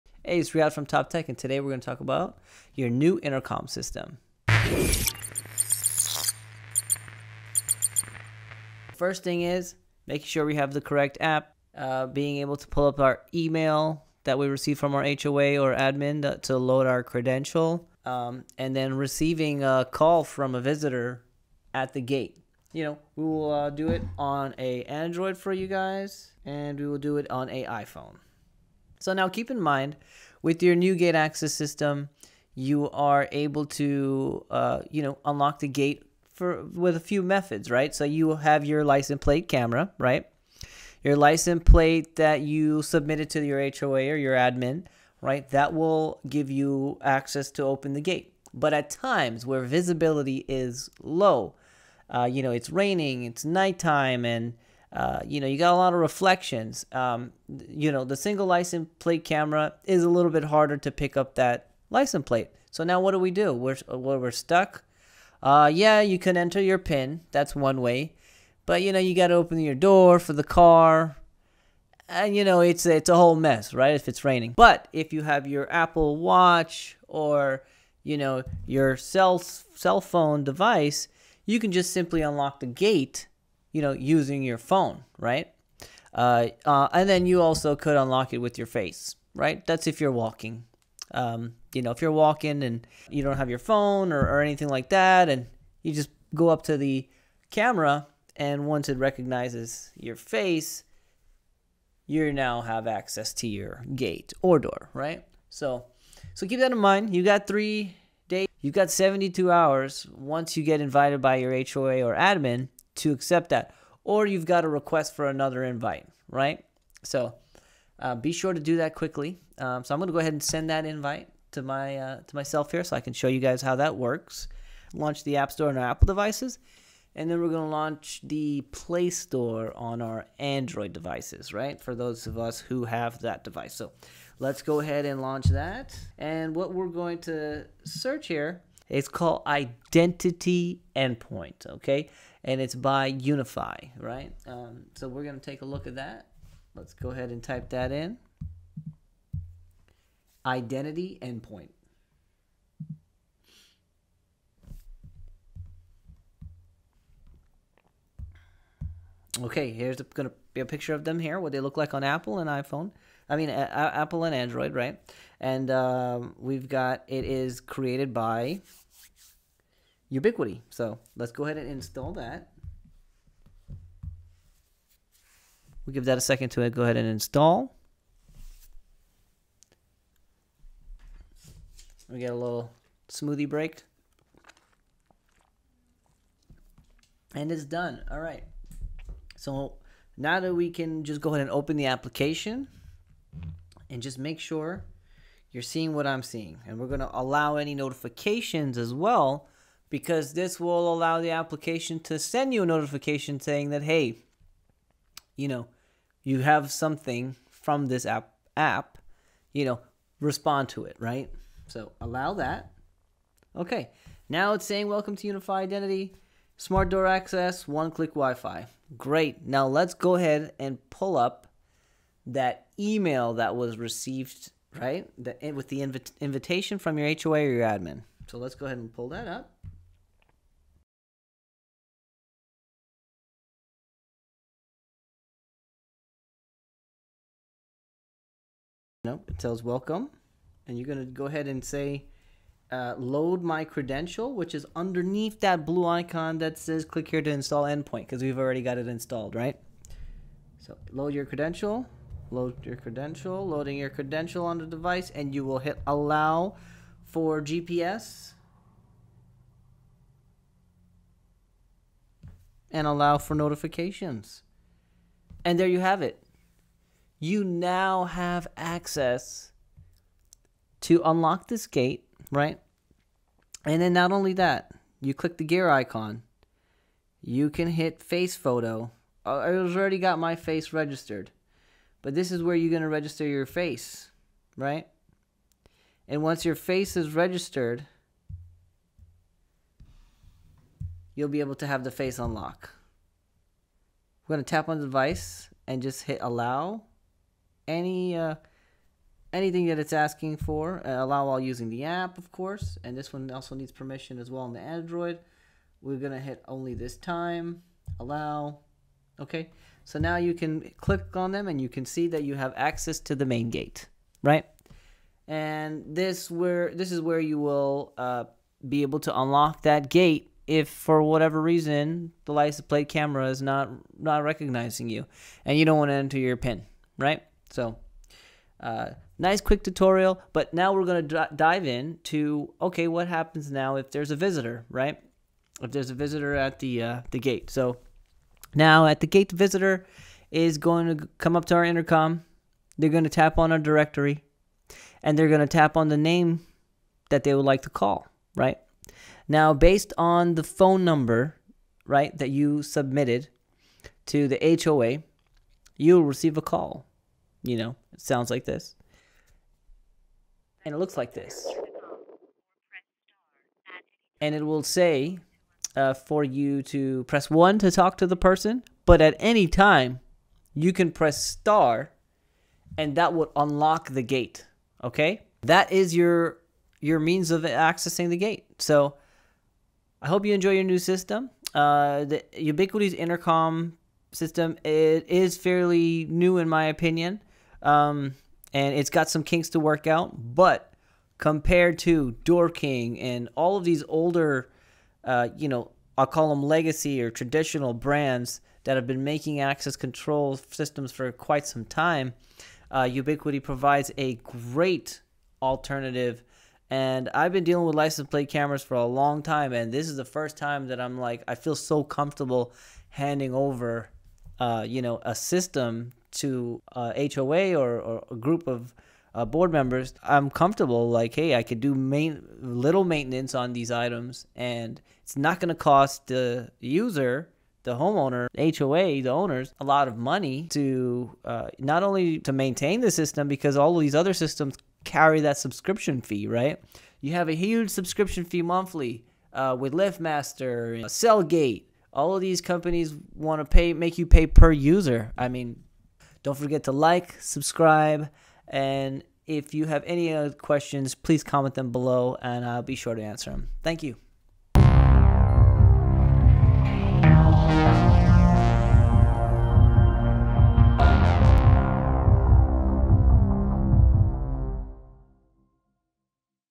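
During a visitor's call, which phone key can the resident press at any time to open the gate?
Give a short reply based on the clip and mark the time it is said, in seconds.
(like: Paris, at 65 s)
Star, at 371 s.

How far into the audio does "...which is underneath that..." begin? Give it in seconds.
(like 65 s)
244 s.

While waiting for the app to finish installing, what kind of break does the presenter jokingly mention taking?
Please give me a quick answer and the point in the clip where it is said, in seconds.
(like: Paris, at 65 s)
Smoothie break, at 183 s.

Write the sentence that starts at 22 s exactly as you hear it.
You know, we will uh, do it on a Android for you guys, and we will do it on a iPhone.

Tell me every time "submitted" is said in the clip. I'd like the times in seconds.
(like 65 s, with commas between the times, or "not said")
42 s, 352 s.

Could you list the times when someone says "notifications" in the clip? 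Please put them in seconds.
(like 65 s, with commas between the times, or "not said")
197 s, 202 s, 263 s.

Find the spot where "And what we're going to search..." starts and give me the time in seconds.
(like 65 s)
136 s.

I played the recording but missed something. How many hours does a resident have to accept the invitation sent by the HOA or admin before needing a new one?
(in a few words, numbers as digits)
72.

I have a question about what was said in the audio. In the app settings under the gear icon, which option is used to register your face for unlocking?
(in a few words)
Face photo.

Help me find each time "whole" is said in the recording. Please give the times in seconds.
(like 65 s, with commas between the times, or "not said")
73 s.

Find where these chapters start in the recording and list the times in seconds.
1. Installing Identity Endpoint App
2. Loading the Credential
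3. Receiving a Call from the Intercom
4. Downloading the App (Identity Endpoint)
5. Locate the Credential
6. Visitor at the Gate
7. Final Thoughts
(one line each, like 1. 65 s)
1. 180 s
2. 245 s
3. 362 s
4. 120 s
5. 225 s
6. 338 s
7. 381 s.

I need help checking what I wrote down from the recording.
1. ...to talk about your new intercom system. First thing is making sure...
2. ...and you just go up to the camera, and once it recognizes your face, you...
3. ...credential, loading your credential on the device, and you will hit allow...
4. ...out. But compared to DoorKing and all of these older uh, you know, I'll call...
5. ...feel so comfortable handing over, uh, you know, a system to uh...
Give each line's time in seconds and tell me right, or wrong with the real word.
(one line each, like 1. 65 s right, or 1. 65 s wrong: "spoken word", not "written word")
1. 1 s right
2. 95 s right
3. 252 s right
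4. 389 s right
5. 411 s right.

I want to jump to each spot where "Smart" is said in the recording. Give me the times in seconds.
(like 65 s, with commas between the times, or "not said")
216 s.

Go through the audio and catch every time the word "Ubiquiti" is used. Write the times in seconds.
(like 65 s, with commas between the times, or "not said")
170 s, 382 s, 402 s.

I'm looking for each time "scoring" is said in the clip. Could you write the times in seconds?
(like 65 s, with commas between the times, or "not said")
not said.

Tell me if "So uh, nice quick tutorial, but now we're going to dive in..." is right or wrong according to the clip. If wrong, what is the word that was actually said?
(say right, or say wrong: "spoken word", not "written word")
right.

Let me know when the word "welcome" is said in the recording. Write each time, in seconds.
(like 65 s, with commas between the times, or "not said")
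214 s, 239 s.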